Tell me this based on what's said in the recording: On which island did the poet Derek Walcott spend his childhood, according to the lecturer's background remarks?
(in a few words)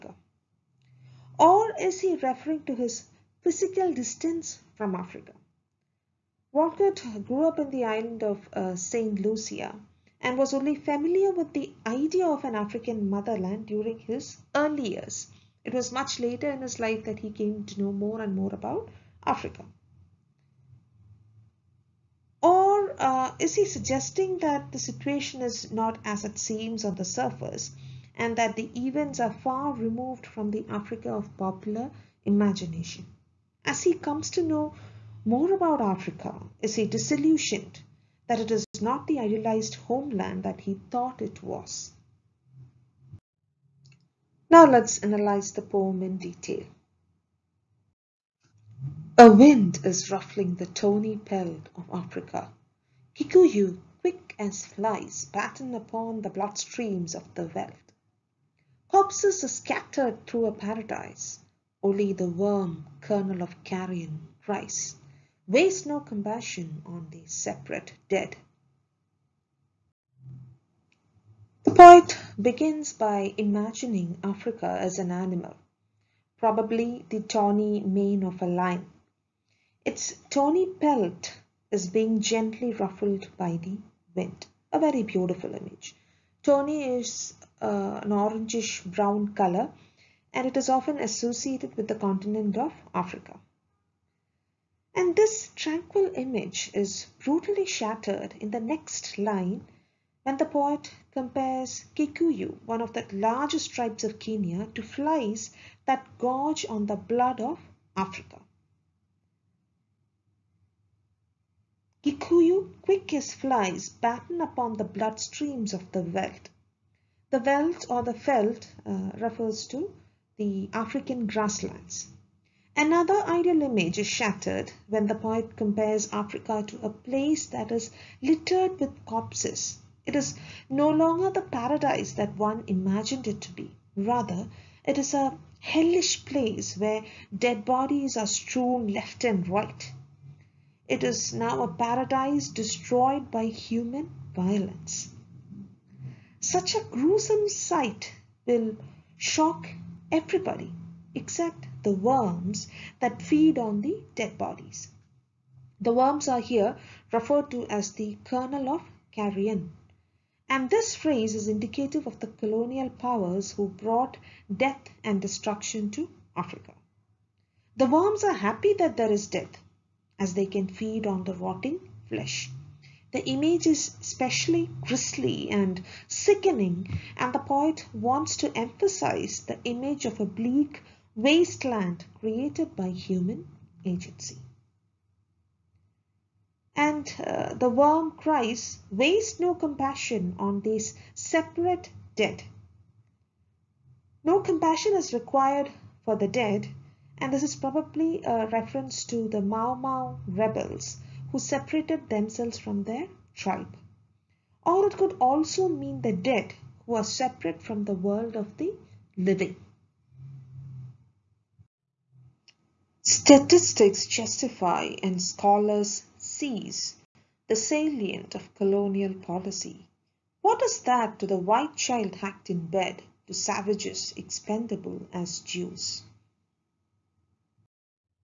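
St. Lucia.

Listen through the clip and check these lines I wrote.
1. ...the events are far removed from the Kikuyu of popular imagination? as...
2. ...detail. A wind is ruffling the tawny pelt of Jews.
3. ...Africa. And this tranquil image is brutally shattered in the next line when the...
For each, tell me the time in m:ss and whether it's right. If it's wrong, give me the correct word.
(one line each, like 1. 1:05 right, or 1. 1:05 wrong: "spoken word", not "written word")
1. 0:28 wrong: "Africa", not "Kikuyu"
2. 0:46 wrong: "Africa", not "Jews"
3. 1:32 right.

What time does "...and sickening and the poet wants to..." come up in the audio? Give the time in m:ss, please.
2:55.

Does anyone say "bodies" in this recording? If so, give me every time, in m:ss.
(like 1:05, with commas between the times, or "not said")
2:17, 2:34.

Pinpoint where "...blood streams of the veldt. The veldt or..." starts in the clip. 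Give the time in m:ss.
1:54.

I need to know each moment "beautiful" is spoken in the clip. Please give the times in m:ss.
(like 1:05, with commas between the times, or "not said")
1:25.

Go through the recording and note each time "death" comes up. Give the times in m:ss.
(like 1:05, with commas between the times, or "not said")
2:44, 2:49.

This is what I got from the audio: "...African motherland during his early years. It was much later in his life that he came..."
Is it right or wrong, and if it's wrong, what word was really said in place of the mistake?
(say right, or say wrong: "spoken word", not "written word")
right.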